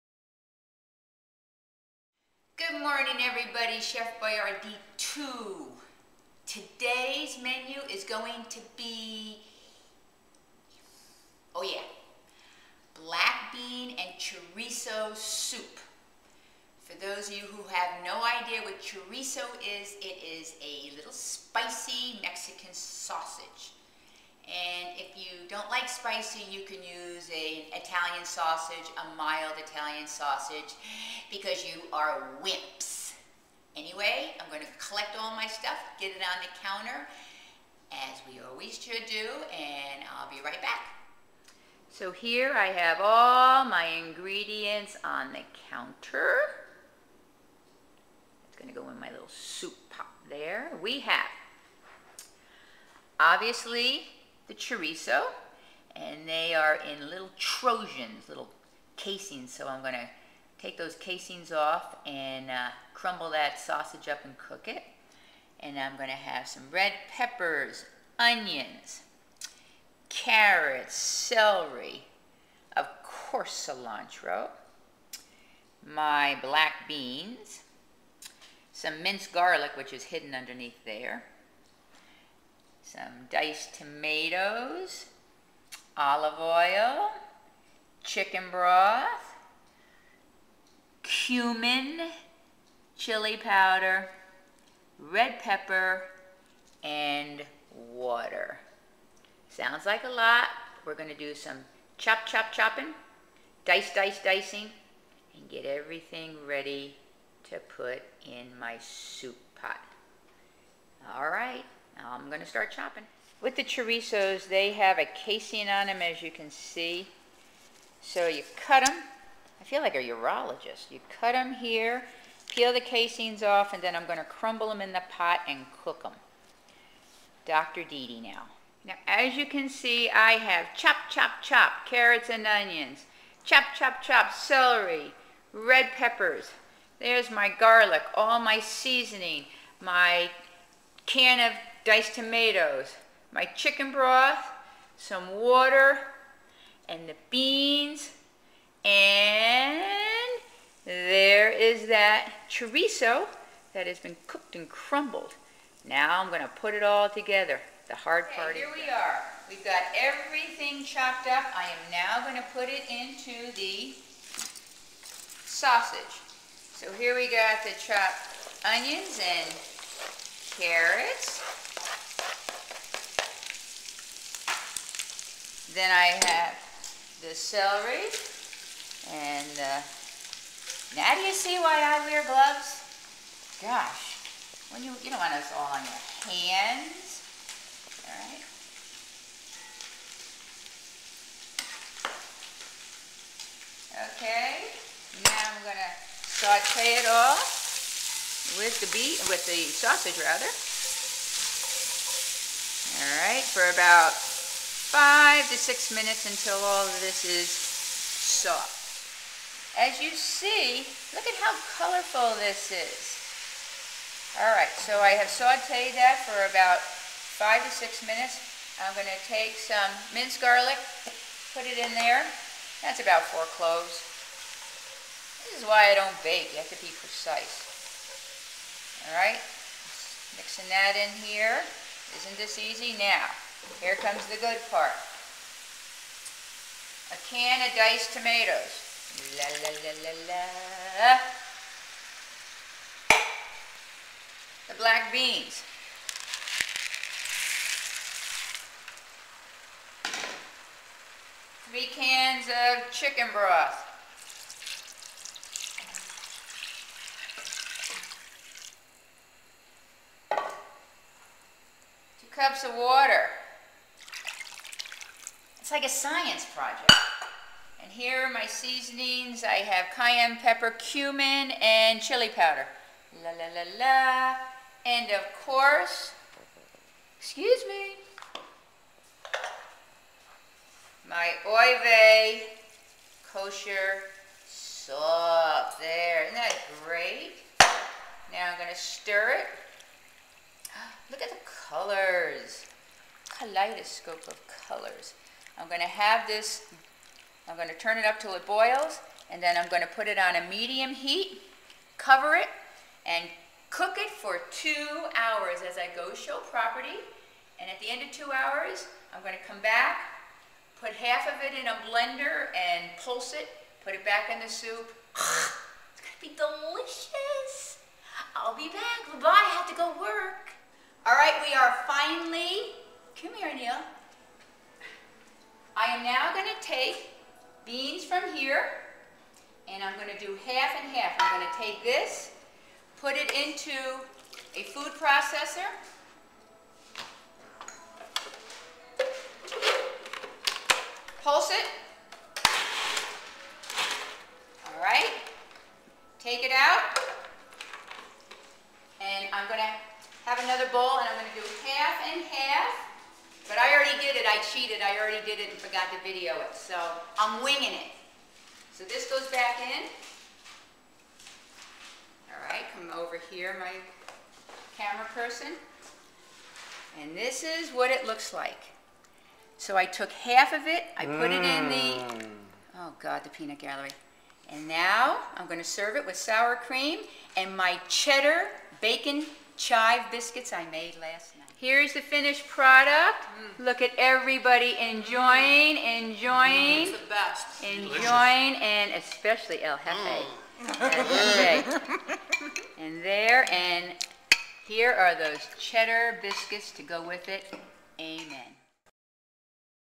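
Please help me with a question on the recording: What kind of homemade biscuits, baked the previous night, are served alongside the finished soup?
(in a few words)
cheddar bacon chive biscuits.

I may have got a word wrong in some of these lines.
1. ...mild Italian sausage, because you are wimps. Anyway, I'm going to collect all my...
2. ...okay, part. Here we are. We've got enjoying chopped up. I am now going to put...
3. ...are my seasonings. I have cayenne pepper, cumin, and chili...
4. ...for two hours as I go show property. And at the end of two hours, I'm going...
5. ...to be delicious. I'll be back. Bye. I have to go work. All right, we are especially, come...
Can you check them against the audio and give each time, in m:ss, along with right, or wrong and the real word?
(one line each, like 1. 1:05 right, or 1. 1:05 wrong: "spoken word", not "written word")
1. 0:29 right
2. 2:38 wrong: "everything", not "enjoying"
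3. 4:28 right
4. 5:04 right
5. 5:16 wrong: "finally", not "especially".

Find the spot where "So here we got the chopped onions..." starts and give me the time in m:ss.
2:46.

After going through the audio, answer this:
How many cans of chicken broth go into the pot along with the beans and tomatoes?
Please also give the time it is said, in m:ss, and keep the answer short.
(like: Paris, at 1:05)
3, at 4:11.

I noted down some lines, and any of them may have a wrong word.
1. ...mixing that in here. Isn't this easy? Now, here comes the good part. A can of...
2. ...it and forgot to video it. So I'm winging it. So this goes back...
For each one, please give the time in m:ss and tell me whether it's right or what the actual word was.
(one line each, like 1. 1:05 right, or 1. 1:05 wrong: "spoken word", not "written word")
1. 3:50 right
2. 5:55 right.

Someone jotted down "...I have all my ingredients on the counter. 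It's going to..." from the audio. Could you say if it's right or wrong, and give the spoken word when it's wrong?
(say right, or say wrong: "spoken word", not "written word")
right.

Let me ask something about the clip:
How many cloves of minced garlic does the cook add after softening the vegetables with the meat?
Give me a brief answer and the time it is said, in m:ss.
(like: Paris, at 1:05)
4, at 3:43.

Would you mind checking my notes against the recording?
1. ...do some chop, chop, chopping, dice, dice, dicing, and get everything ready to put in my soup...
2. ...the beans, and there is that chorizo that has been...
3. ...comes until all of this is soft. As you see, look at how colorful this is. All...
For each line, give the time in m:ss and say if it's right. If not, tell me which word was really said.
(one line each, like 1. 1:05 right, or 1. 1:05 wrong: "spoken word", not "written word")
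1. 1:41 right
2. 2:27 right
3. 3:25 wrong: "minutes", not "comes".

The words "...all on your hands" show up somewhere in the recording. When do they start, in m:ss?
3:05.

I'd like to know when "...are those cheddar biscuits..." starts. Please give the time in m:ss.
6:34.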